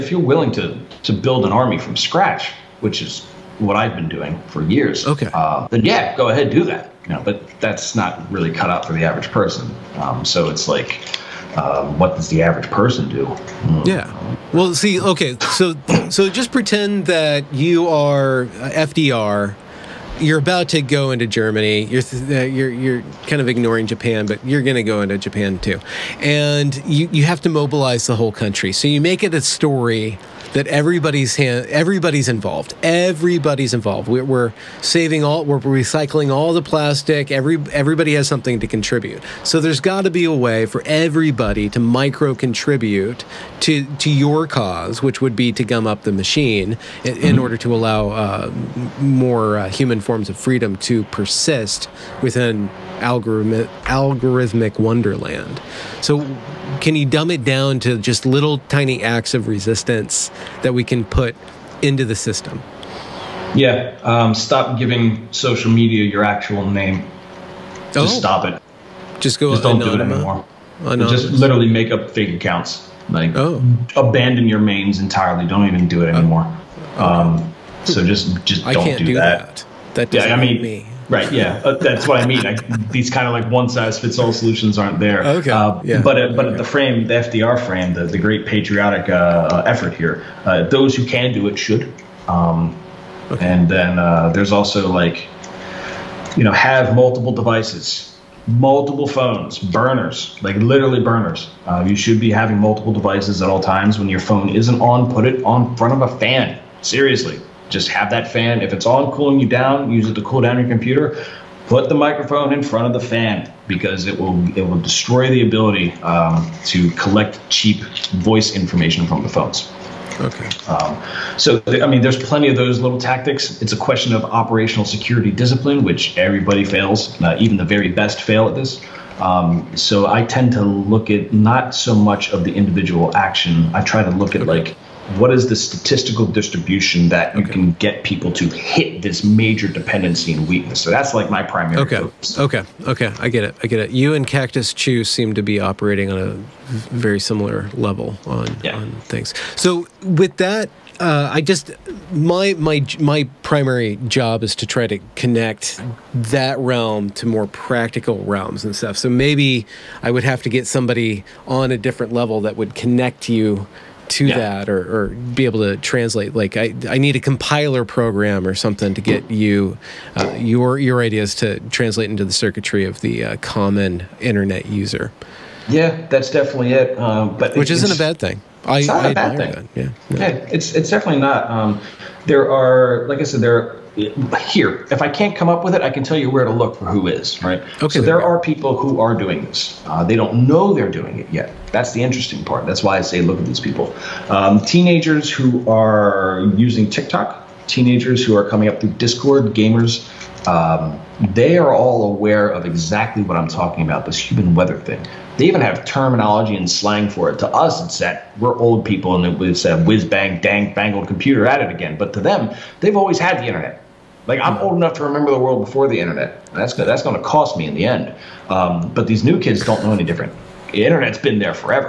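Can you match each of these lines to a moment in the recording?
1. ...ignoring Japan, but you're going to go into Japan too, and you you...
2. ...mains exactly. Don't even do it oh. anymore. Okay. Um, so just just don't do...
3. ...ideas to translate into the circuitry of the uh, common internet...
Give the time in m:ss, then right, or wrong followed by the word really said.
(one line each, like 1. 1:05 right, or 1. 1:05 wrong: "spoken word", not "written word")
1. 0:23 right
2. 1:14 wrong: "entirely", not "exactly"
3. 2:51 right.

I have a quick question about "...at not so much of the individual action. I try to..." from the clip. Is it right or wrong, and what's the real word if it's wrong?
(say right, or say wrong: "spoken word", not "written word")
right.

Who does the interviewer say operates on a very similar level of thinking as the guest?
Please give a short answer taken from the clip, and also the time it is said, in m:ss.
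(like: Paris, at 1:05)
Cactus Chu, at 2:24.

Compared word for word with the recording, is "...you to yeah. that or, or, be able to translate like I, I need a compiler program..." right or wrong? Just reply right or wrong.
right.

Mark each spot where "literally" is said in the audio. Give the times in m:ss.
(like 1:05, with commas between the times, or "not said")
1:11, 1:40.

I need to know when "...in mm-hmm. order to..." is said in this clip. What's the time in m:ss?
0:47.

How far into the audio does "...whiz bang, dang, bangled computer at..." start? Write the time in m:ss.
3:29.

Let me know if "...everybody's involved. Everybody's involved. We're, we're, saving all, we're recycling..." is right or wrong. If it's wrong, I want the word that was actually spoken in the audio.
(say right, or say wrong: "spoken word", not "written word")
right.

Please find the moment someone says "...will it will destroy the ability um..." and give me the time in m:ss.
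1:54.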